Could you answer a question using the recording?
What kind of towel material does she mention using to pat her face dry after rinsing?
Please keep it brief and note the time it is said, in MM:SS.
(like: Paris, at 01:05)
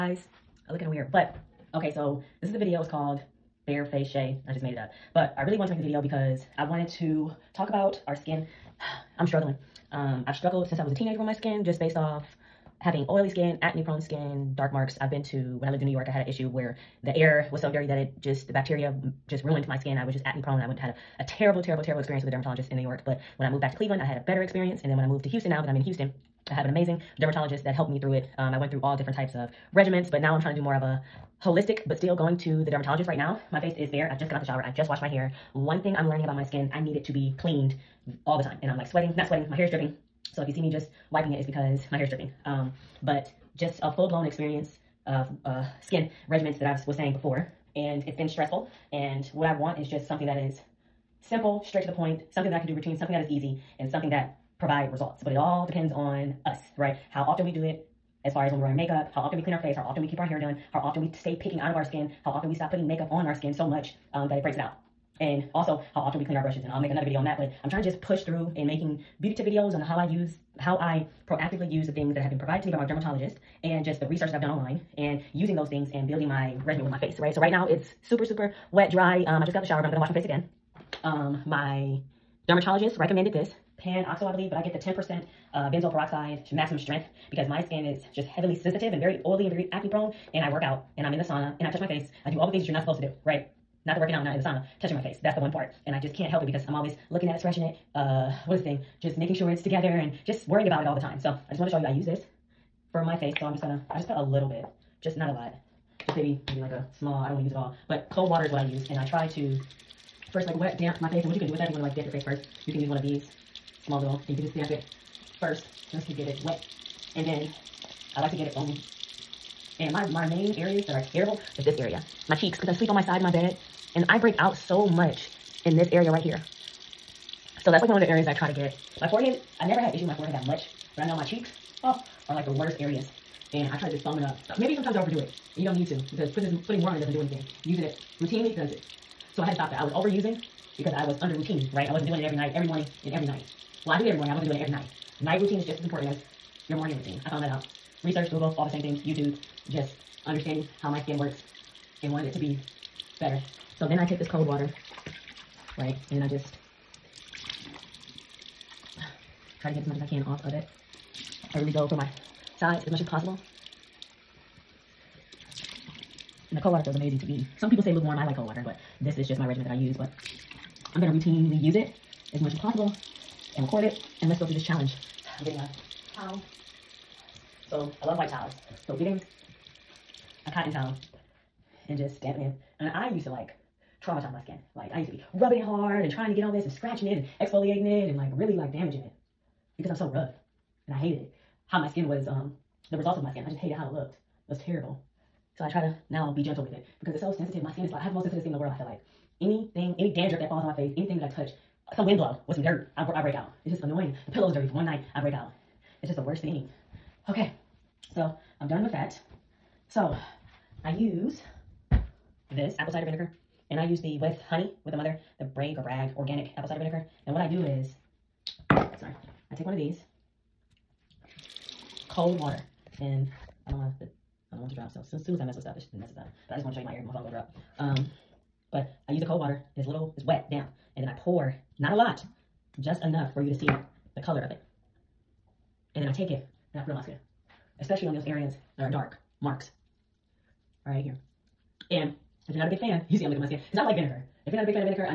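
cotton, at 03:00.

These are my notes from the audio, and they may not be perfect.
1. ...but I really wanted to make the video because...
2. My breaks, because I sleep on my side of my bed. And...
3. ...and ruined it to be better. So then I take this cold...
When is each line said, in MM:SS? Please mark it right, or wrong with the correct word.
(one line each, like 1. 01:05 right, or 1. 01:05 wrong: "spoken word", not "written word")
1. 00:05 right
2. 02:02 wrong: "cheeks", not "breaks"
3. 02:32 wrong: "wanted", not "ruined".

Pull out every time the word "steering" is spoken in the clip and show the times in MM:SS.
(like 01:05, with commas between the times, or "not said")
not said.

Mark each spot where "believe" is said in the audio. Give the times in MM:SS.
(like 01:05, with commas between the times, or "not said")
01:24.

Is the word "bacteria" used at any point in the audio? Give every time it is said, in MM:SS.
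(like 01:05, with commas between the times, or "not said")
00:18.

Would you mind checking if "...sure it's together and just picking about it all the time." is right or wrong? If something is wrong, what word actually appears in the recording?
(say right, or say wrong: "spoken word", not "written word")
wrong: "worrying", not "picking".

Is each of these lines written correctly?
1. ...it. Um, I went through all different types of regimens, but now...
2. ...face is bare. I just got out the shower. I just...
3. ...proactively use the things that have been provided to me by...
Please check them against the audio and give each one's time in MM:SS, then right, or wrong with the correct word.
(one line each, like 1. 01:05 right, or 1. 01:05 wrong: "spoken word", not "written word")
1. 00:28 right
2. 00:33 right
3. 01:11 right.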